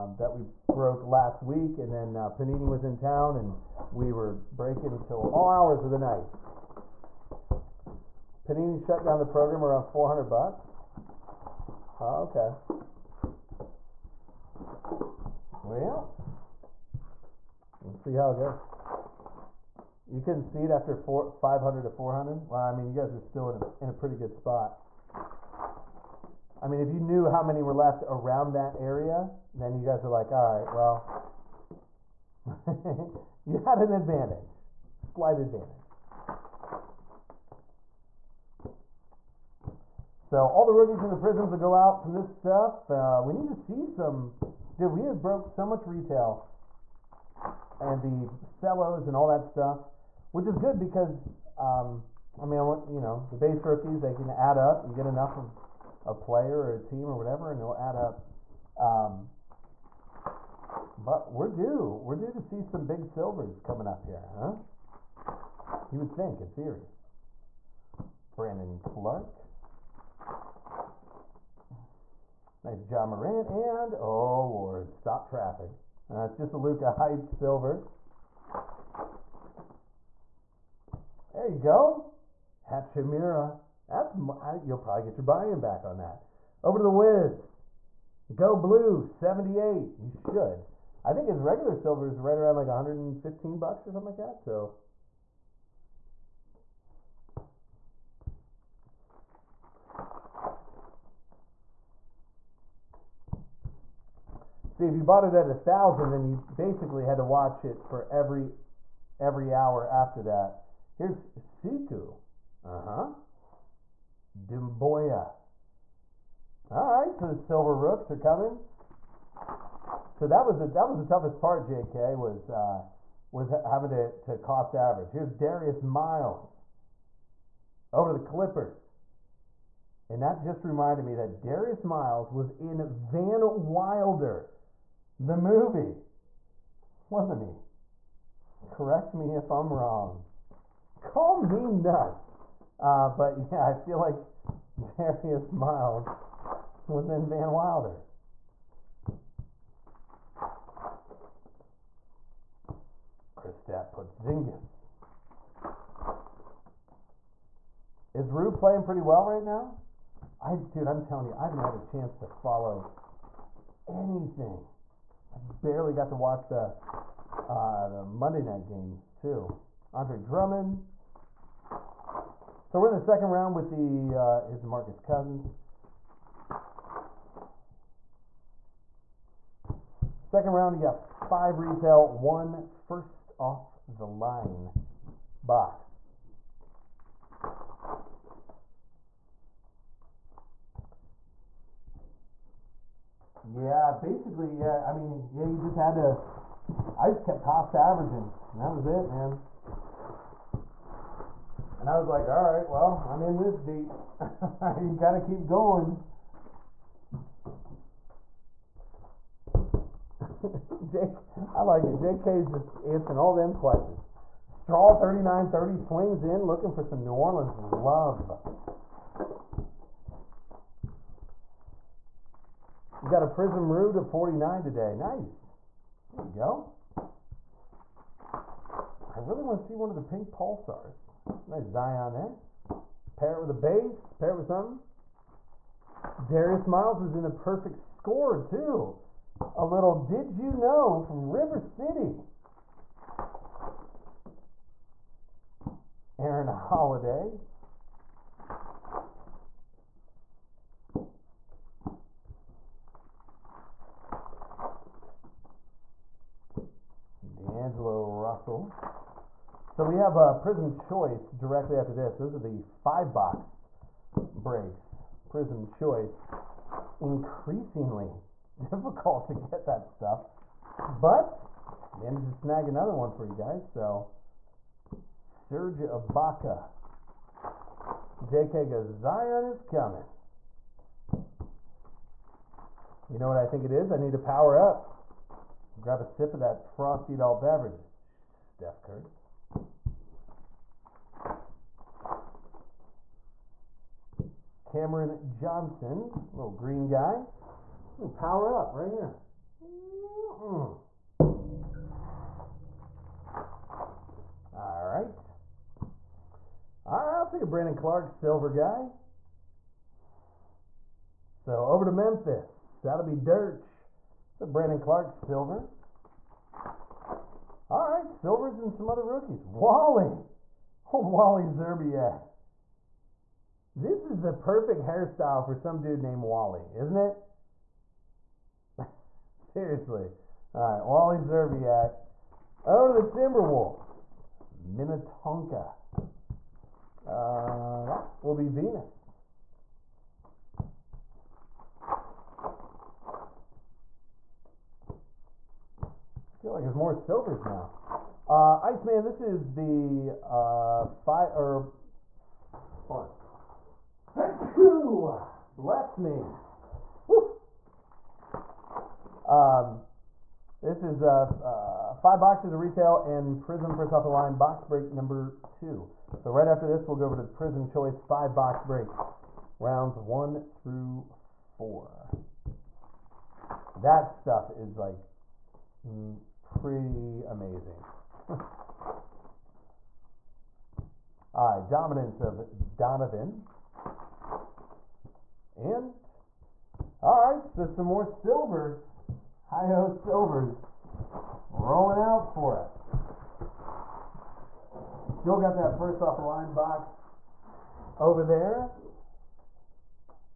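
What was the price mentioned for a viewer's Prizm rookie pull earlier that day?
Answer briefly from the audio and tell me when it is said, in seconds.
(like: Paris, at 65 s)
49, at 224 s.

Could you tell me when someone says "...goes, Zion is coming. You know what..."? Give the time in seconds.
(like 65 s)
278 s.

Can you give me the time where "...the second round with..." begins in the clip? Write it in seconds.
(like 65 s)
172 s.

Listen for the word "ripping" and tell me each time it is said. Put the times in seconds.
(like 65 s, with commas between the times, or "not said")
not said.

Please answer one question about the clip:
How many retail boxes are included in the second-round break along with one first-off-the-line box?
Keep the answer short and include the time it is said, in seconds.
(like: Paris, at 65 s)
5, at 180 s.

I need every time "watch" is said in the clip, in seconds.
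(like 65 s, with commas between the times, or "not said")
107 s, 166 s.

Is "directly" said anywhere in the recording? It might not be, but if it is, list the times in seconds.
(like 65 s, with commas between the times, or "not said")
261 s.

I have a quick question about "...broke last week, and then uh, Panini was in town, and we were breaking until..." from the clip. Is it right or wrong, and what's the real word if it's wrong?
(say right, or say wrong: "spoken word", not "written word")
right.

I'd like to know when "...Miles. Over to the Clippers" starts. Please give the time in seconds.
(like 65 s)
125 s.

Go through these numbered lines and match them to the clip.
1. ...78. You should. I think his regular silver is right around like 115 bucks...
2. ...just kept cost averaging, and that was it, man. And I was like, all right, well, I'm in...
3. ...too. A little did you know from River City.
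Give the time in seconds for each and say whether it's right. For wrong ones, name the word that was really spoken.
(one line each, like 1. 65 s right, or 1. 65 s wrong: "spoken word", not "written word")
1. 89 s right
2. 197 s right
3. 238 s right.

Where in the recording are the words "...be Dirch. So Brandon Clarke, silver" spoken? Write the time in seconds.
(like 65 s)
313 s.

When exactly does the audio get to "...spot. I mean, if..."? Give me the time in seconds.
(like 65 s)
24 s.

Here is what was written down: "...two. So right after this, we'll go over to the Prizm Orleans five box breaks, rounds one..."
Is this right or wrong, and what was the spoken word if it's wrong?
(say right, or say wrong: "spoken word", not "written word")
wrong: "Choice", not "Orleans".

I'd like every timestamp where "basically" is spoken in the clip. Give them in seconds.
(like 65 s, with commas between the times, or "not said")
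106 s, 193 s.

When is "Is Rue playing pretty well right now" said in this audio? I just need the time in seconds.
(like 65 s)
158 s.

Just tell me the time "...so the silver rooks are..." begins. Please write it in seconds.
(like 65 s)
117 s.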